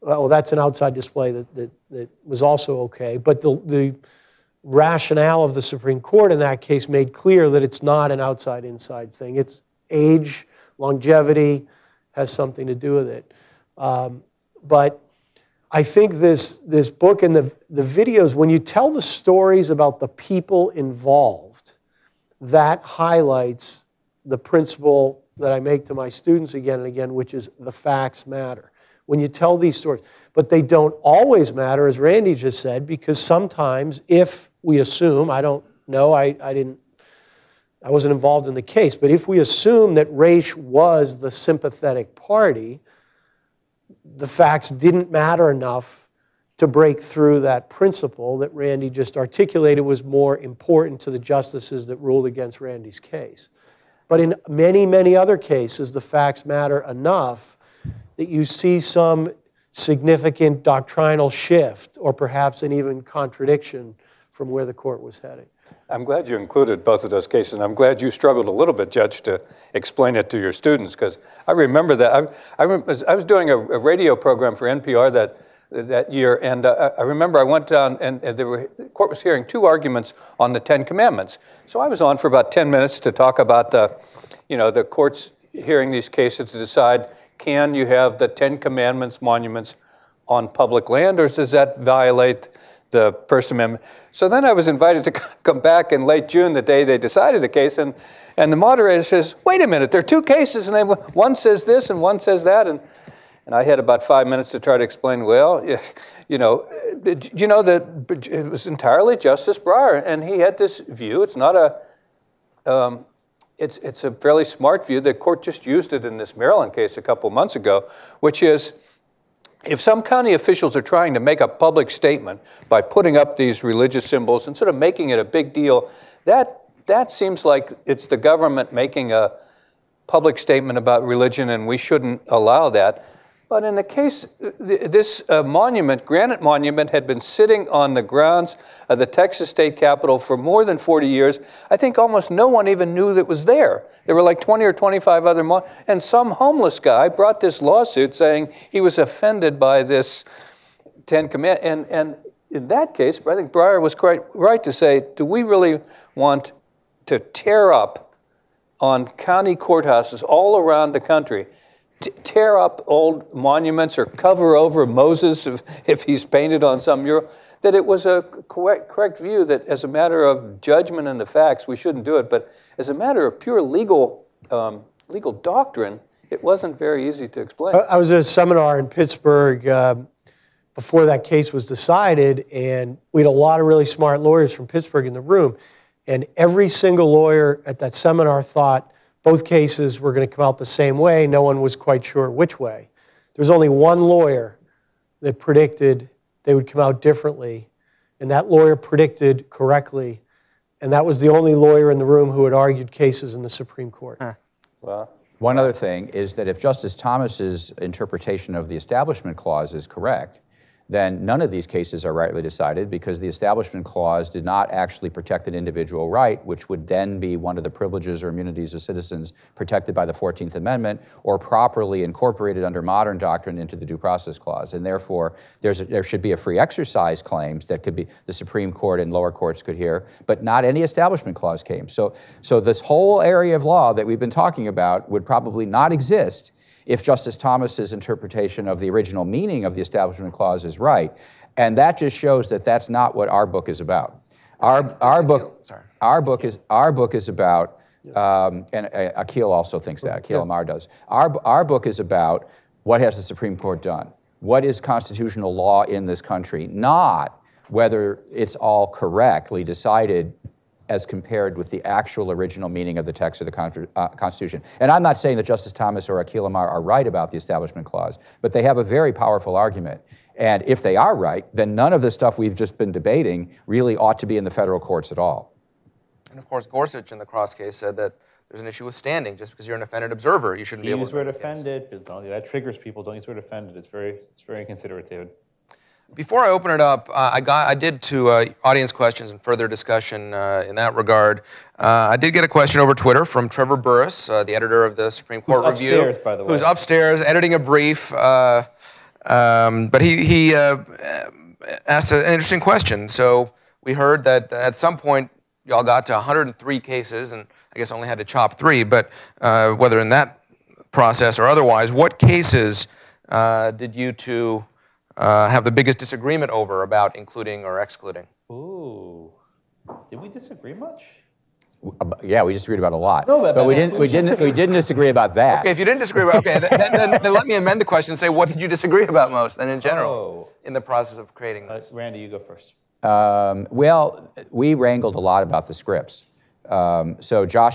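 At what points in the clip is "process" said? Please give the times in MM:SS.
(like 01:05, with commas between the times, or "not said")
03:43, 05:10, 05:30.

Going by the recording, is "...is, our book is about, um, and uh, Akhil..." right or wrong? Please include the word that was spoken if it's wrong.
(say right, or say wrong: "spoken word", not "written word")
right.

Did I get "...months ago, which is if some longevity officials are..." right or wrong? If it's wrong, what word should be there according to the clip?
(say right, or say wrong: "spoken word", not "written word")
wrong: "county", not "longevity".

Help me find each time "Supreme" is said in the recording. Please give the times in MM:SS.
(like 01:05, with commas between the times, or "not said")
00:05, 03:23, 03:48, 04:13, 04:55.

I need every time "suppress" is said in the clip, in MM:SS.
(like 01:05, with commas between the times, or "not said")
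not said.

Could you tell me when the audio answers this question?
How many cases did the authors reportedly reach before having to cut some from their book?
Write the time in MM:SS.
05:06.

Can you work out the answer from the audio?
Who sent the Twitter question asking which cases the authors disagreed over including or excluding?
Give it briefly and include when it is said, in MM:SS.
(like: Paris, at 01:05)
Trevor Burrus, at 04:53.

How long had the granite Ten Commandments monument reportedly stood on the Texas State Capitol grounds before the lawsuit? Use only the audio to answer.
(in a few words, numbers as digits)
more than 40 years.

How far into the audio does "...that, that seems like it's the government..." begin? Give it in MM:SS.
02:06.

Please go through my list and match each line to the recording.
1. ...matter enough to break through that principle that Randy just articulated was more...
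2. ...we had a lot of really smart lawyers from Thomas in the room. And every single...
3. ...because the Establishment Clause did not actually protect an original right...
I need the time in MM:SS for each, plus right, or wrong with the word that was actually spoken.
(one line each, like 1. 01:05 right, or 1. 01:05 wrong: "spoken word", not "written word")
1. 00:45 right
2. 03:03 wrong: "Pittsburgh", not "Thomas"
3. 03:32 wrong: "individual", not "original".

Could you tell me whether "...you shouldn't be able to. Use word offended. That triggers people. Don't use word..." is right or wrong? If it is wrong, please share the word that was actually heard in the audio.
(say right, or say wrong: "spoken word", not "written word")
right.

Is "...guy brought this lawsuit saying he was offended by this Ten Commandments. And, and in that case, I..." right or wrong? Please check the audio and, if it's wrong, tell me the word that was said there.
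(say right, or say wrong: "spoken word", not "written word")
right.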